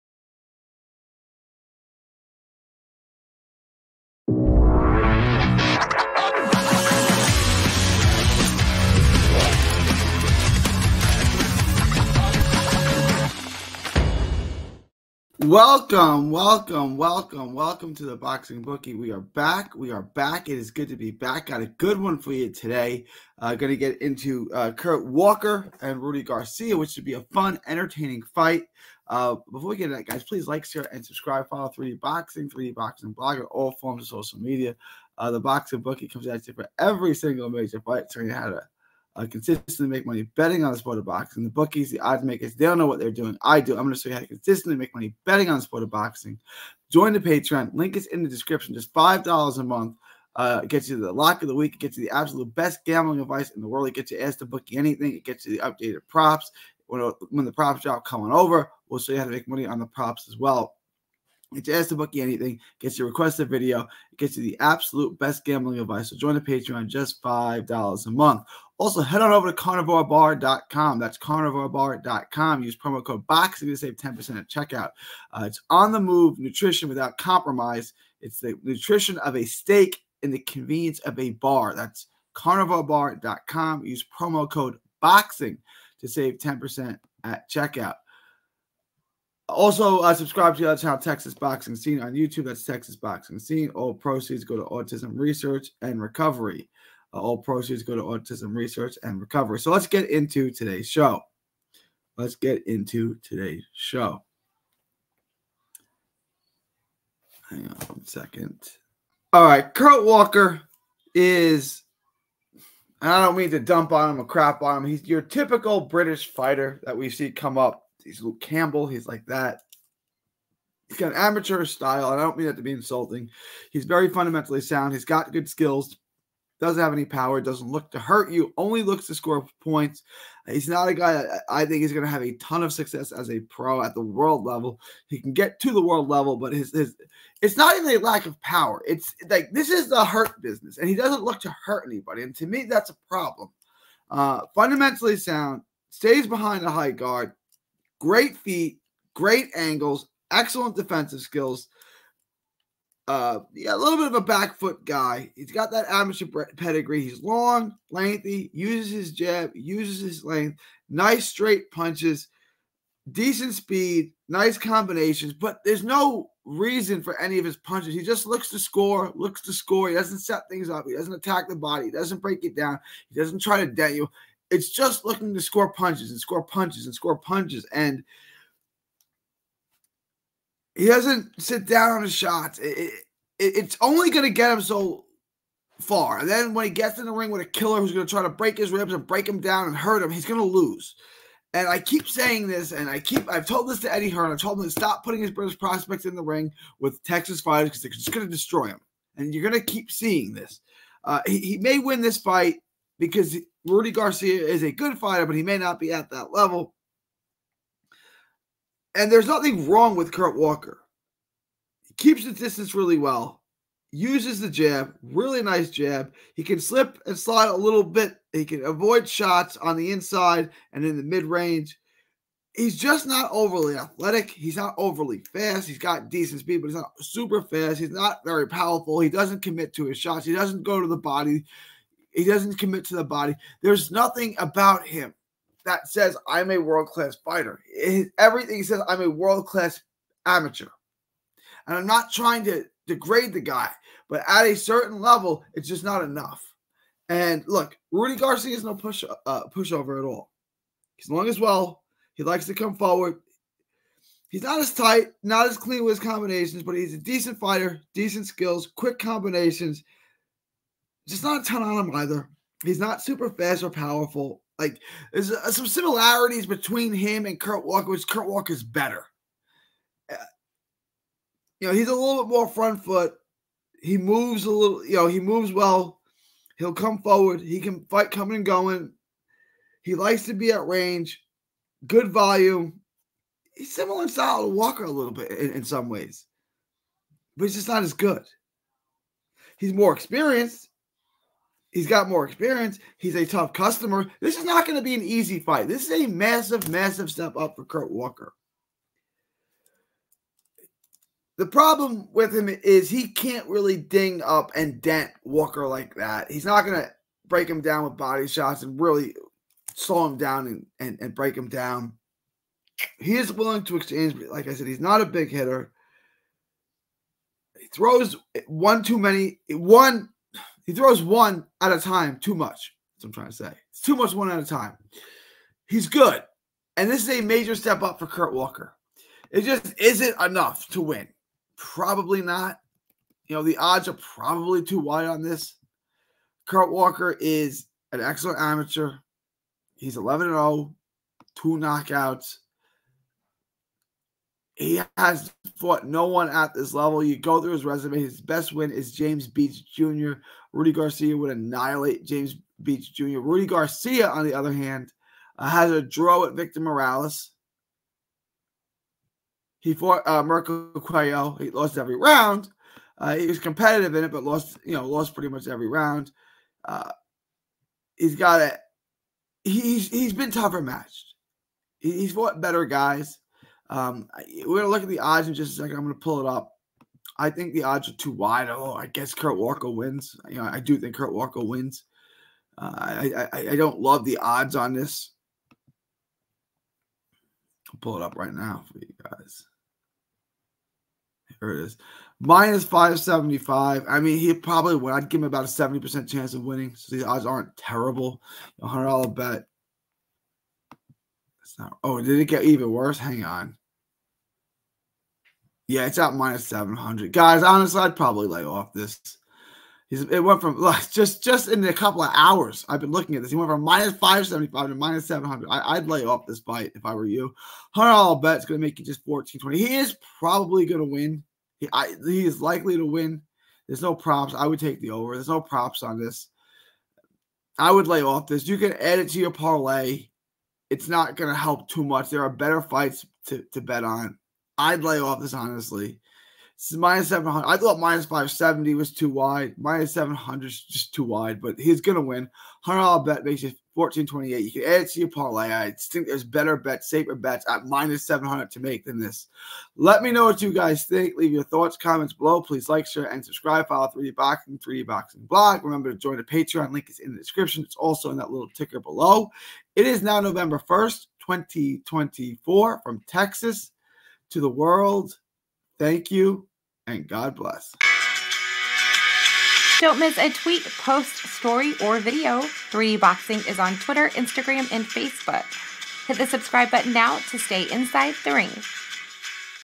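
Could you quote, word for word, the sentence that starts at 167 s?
He just looks to score, looks to score.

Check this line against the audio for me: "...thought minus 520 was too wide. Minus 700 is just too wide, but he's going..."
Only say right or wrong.
wrong.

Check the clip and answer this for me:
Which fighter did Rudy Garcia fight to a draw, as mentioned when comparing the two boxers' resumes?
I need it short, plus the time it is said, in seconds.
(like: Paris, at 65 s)
Victor Morales, at 356 s.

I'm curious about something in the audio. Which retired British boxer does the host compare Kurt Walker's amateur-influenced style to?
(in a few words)
Luke Campbell.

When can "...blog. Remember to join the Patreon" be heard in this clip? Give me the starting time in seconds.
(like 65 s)
455 s.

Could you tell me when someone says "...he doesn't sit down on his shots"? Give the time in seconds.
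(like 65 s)
180 s.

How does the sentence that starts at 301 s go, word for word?
The problem with him is he can't really ding up and dent Walker like that.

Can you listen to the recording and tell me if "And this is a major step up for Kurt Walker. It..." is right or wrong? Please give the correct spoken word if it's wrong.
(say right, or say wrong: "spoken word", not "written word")
right.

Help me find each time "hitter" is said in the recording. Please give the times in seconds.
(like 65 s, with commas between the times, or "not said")
315 s.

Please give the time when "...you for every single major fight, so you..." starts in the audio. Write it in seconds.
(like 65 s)
36 s.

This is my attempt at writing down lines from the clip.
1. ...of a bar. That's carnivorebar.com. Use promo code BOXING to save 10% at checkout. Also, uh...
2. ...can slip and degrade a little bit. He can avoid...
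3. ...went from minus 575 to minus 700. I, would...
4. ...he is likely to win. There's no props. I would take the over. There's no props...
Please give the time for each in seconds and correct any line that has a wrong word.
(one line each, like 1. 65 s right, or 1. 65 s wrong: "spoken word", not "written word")
1. 81 s right
2. 216 s wrong: "slide", not "degrade"
3. 413 s right
4. 422 s right.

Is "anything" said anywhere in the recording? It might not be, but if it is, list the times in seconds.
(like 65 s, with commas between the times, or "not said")
54 s, 62 s.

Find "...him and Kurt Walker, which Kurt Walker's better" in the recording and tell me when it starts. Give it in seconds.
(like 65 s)
266 s.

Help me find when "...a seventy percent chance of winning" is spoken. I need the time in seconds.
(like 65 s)
395 s.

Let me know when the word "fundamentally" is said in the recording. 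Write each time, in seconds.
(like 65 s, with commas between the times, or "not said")
124 s, 144 s.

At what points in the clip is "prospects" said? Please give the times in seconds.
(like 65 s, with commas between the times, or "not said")
195 s.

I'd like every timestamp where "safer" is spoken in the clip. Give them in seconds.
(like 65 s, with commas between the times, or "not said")
446 s.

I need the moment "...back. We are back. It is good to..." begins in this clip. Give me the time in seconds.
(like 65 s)
19 s.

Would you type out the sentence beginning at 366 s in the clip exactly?
Uh, he's got a he's he's been tougher matched.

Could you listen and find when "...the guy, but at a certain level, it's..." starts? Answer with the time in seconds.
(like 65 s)
243 s.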